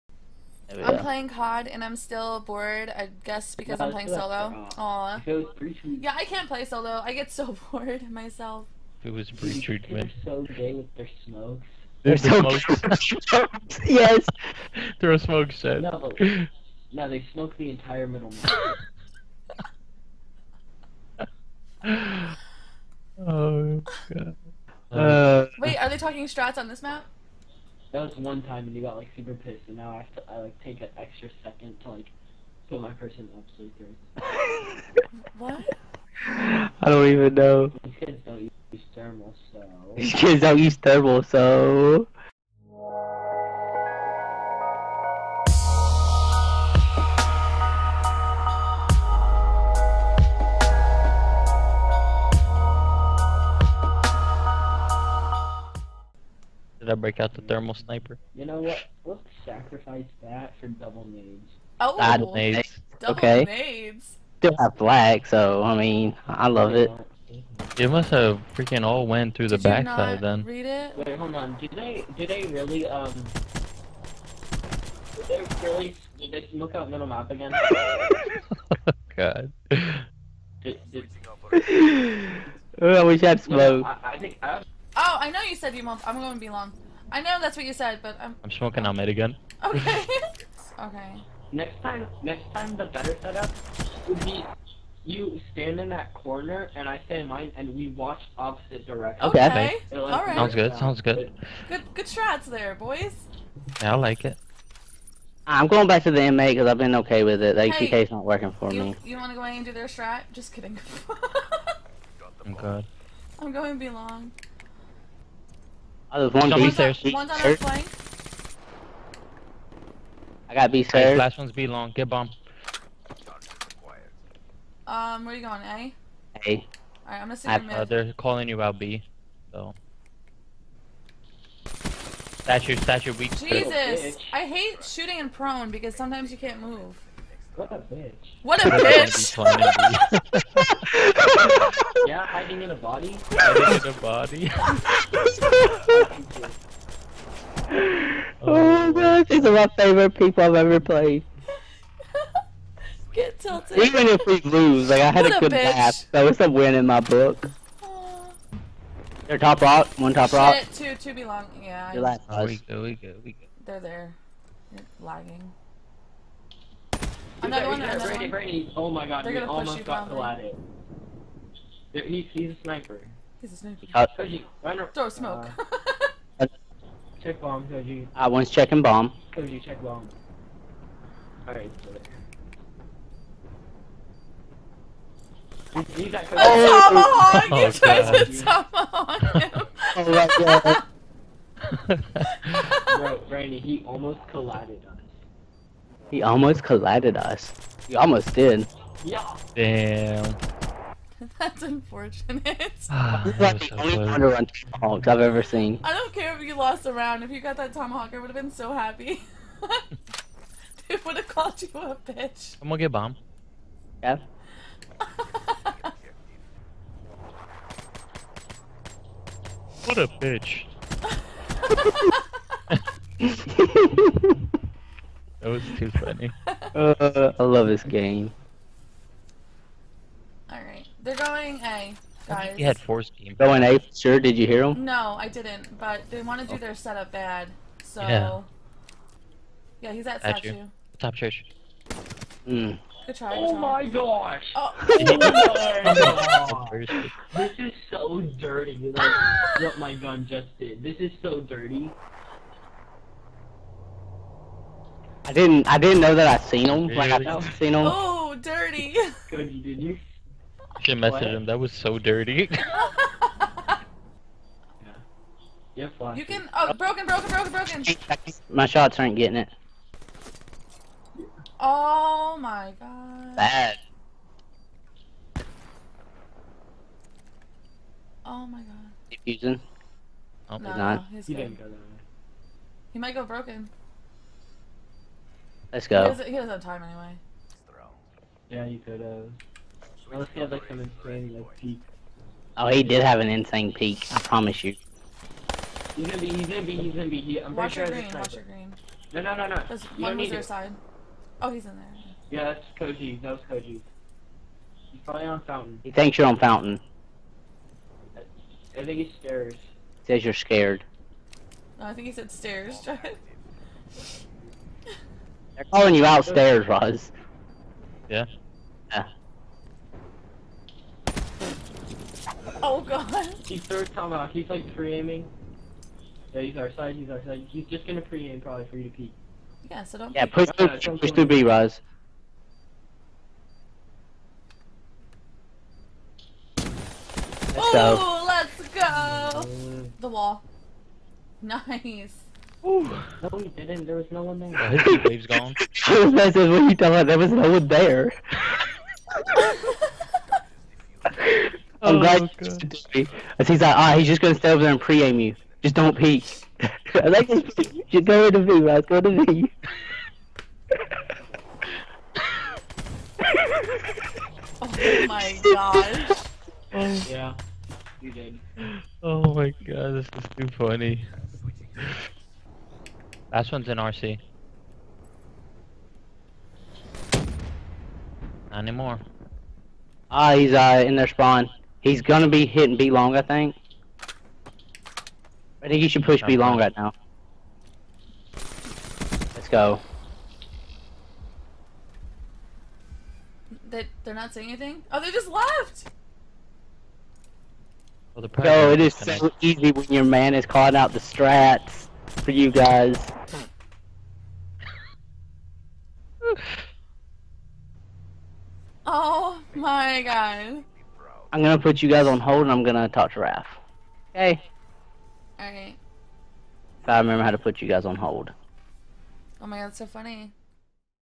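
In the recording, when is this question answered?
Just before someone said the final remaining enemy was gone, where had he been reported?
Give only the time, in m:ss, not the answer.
6:13.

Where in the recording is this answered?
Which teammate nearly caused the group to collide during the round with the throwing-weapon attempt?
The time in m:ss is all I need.
3:13.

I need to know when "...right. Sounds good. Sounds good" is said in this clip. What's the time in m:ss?
1:40.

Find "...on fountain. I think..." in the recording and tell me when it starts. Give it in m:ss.
5:06.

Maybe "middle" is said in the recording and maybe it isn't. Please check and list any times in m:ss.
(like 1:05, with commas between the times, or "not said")
0:18, 1:16.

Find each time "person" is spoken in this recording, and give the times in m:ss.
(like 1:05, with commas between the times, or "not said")
0:32.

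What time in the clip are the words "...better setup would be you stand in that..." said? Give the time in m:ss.
1:32.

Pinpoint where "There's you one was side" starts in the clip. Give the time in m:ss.
4:59.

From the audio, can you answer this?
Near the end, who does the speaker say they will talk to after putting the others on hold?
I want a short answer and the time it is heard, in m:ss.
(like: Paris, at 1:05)
Raph, at 6:53.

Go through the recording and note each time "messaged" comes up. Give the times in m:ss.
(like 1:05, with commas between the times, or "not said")
4:20.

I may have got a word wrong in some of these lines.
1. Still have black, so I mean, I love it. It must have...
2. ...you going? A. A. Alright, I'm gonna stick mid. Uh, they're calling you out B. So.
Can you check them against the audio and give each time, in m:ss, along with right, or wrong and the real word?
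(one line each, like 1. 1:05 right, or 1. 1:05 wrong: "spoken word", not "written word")
1. 1:04 right
2. 2:05 right.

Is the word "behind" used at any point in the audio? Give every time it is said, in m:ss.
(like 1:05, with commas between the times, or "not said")
not said.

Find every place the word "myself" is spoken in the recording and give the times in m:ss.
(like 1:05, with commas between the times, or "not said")
0:08.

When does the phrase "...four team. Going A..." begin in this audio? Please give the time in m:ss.
3:52.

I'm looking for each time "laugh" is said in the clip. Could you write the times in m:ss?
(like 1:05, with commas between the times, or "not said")
2:35.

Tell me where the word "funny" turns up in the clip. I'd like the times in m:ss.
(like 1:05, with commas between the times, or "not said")
3:45, 6:10, 6:59.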